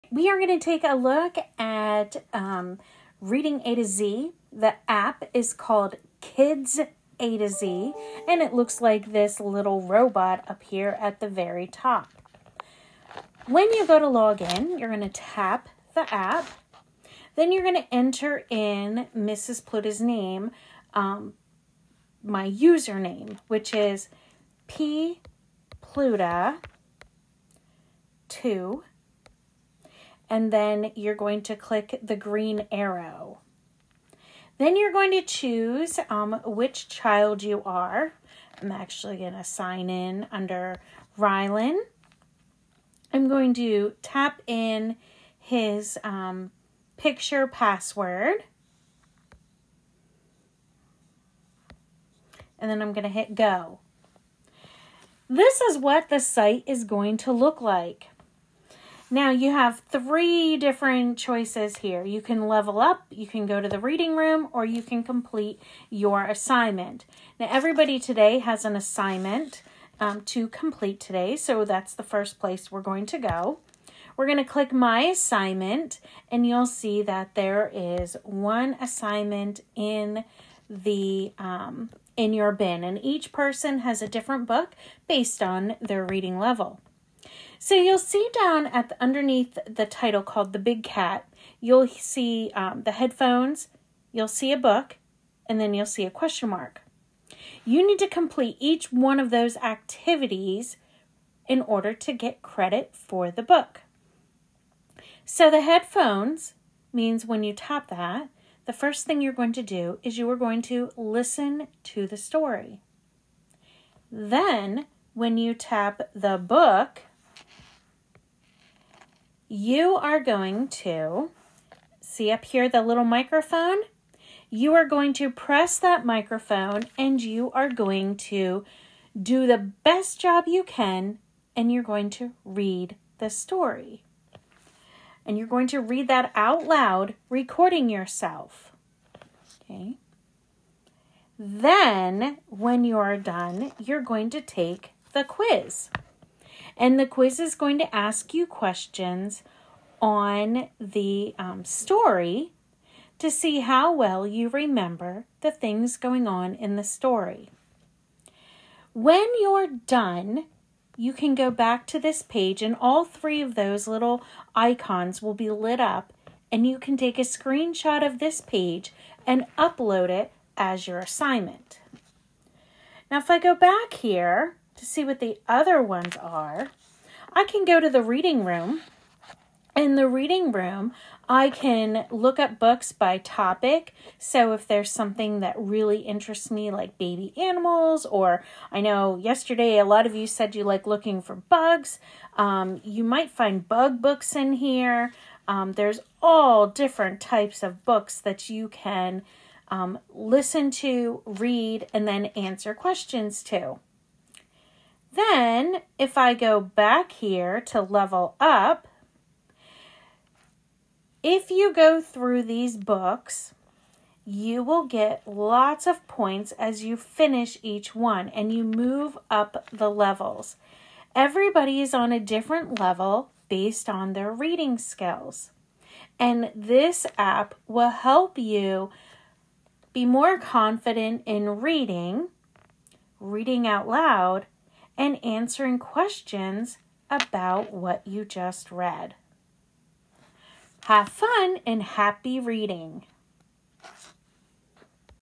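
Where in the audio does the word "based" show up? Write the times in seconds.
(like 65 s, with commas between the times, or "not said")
85 s, 223 s.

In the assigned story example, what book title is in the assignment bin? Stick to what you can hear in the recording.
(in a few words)
The Big Cat.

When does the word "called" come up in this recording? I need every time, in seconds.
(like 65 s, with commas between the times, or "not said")
5 s, 90 s.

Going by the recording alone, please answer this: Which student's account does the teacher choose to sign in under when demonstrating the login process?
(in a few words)
Rylan.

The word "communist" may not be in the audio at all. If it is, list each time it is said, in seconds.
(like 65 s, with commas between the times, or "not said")
not said.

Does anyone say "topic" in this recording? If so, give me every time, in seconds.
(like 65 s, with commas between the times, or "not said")
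183 s.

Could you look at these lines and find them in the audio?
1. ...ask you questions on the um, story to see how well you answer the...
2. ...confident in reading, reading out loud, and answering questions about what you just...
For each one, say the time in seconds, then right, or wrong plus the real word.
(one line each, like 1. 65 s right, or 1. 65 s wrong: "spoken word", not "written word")
1. 147 s wrong: "remember", not "answer"
2. 230 s right.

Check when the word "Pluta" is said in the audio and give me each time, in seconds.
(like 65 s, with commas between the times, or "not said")
19 s, 25 s.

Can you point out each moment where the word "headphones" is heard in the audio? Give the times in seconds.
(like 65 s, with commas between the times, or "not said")
92 s, 105 s.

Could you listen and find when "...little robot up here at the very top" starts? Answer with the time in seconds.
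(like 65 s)
9 s.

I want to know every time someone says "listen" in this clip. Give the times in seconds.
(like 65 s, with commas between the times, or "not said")
110 s, 200 s.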